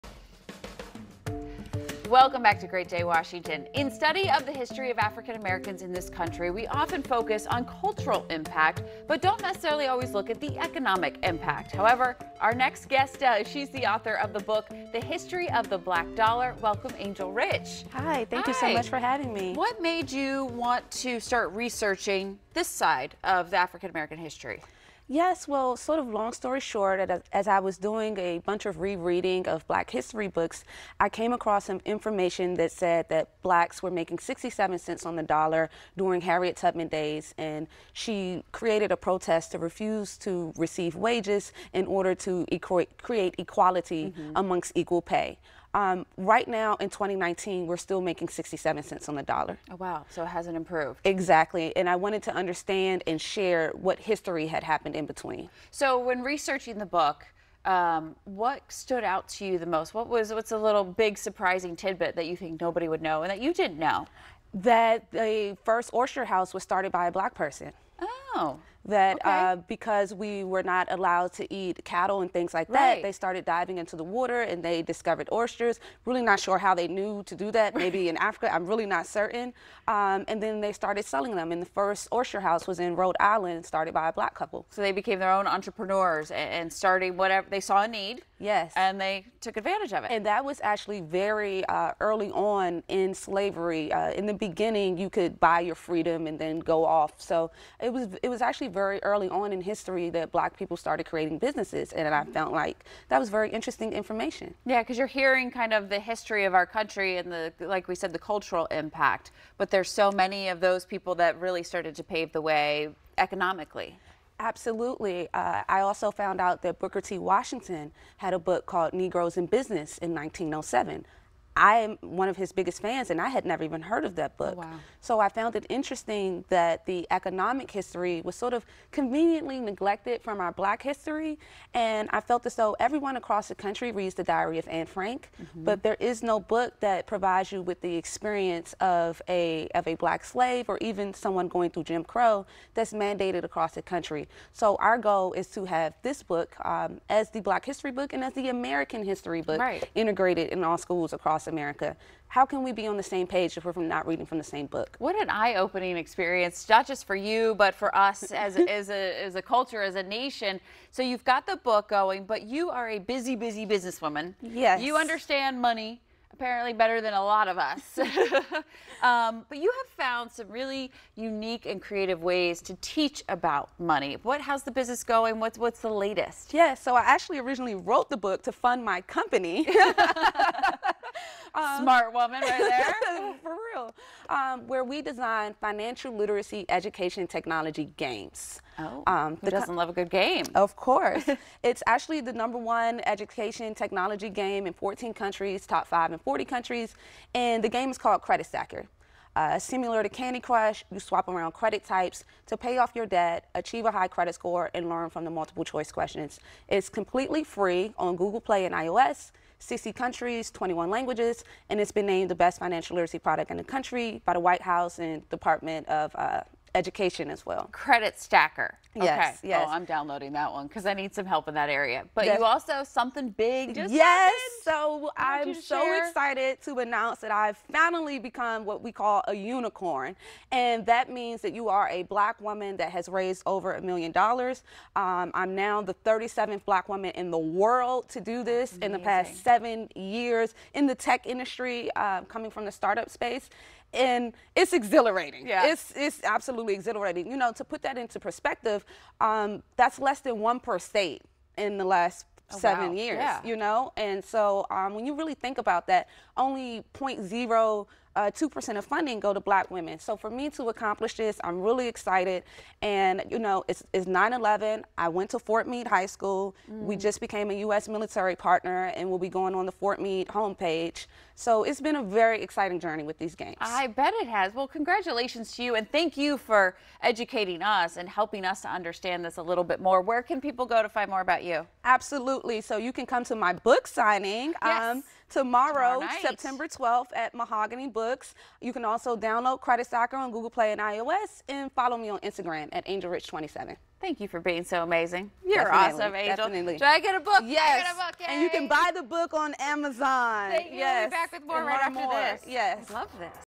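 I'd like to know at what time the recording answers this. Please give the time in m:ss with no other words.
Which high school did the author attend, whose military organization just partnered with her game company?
4:25.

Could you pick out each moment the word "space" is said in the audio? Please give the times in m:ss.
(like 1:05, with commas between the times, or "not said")
4:03.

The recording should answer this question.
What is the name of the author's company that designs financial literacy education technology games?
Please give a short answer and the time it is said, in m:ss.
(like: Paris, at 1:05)
Smart Woman, at 3:01.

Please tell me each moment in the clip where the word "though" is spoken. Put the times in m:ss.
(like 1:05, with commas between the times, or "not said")
2:12.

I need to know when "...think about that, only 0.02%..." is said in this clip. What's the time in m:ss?
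4:15.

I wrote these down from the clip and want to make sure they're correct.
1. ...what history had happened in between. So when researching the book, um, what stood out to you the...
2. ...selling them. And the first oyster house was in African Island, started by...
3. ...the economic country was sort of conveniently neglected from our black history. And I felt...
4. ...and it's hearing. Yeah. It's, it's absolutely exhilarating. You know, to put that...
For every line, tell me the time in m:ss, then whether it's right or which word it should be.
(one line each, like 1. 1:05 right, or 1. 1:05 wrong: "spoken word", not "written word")
1. 0:53 right
2. 1:21 wrong: "Rhode", not "African"
3. 2:06 wrong: "history", not "country"
4. 4:03 wrong: "exhilarating", not "hearing".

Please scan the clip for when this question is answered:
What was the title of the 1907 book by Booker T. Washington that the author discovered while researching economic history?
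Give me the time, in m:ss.
1:58.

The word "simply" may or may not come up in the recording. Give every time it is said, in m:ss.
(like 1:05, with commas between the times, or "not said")
not said.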